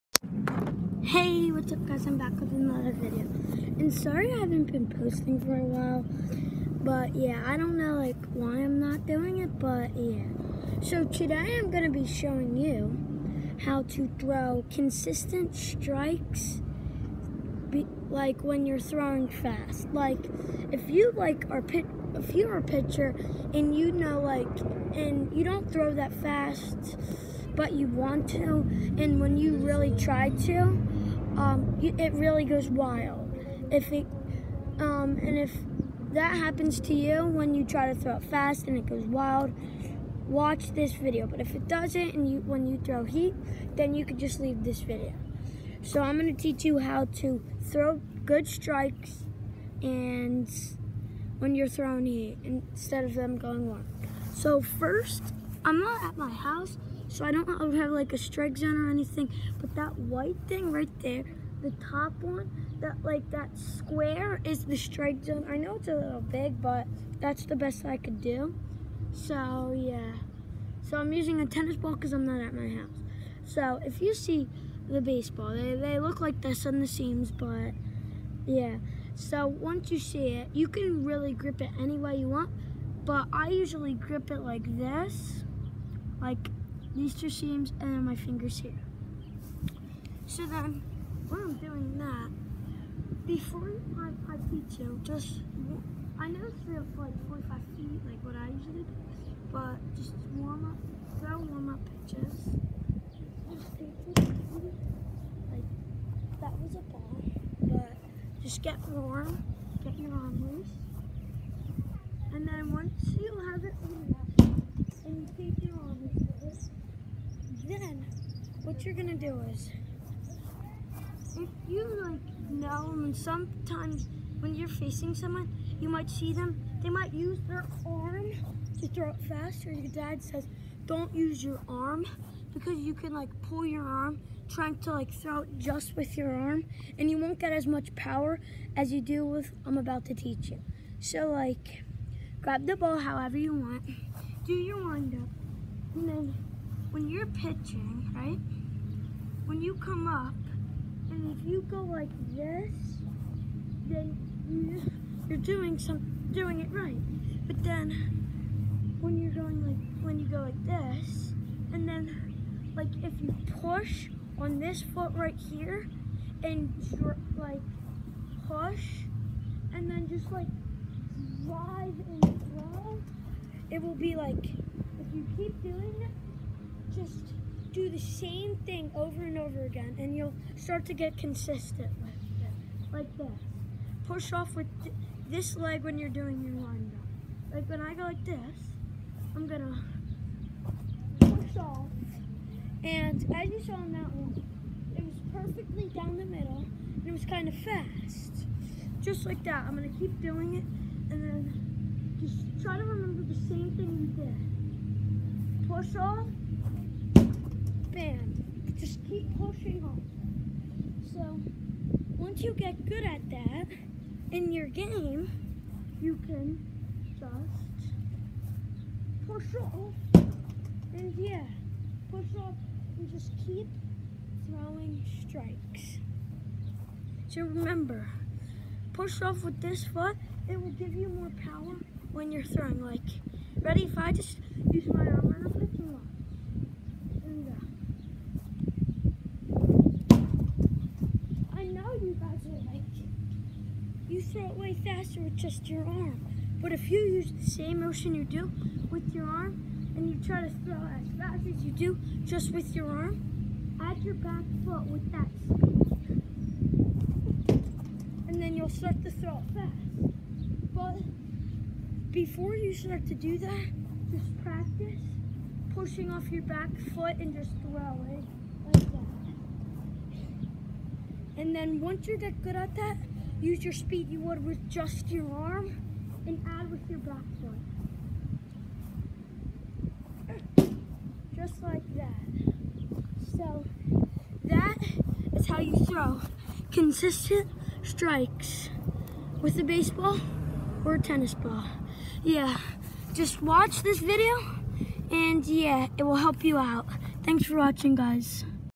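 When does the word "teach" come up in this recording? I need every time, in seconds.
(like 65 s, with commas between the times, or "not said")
46 s, 94 s, 140 s.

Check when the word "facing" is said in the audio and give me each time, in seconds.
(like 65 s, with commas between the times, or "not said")
124 s.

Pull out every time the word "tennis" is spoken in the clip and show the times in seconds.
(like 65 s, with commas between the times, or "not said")
71 s, 291 s.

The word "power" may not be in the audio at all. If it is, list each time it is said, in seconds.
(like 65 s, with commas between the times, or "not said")
137 s, 231 s.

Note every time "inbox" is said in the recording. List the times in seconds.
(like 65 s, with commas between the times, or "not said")
not said.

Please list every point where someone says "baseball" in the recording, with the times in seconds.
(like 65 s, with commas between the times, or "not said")
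75 s, 289 s.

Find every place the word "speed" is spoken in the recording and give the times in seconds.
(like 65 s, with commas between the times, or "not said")
256 s, 273 s.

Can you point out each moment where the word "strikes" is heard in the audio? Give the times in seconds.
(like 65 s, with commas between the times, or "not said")
15 s, 48 s, 58 s, 64 s, 225 s, 287 s.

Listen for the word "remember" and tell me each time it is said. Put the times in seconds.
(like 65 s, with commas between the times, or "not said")
202 s, 227 s.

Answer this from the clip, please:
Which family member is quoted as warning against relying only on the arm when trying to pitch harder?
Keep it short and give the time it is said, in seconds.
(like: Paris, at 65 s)
dad, at 129 s.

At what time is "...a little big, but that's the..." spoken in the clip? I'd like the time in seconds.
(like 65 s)
65 s.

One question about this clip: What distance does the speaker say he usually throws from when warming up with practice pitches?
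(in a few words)
45 feet.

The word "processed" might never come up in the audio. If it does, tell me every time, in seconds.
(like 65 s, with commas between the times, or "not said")
not said.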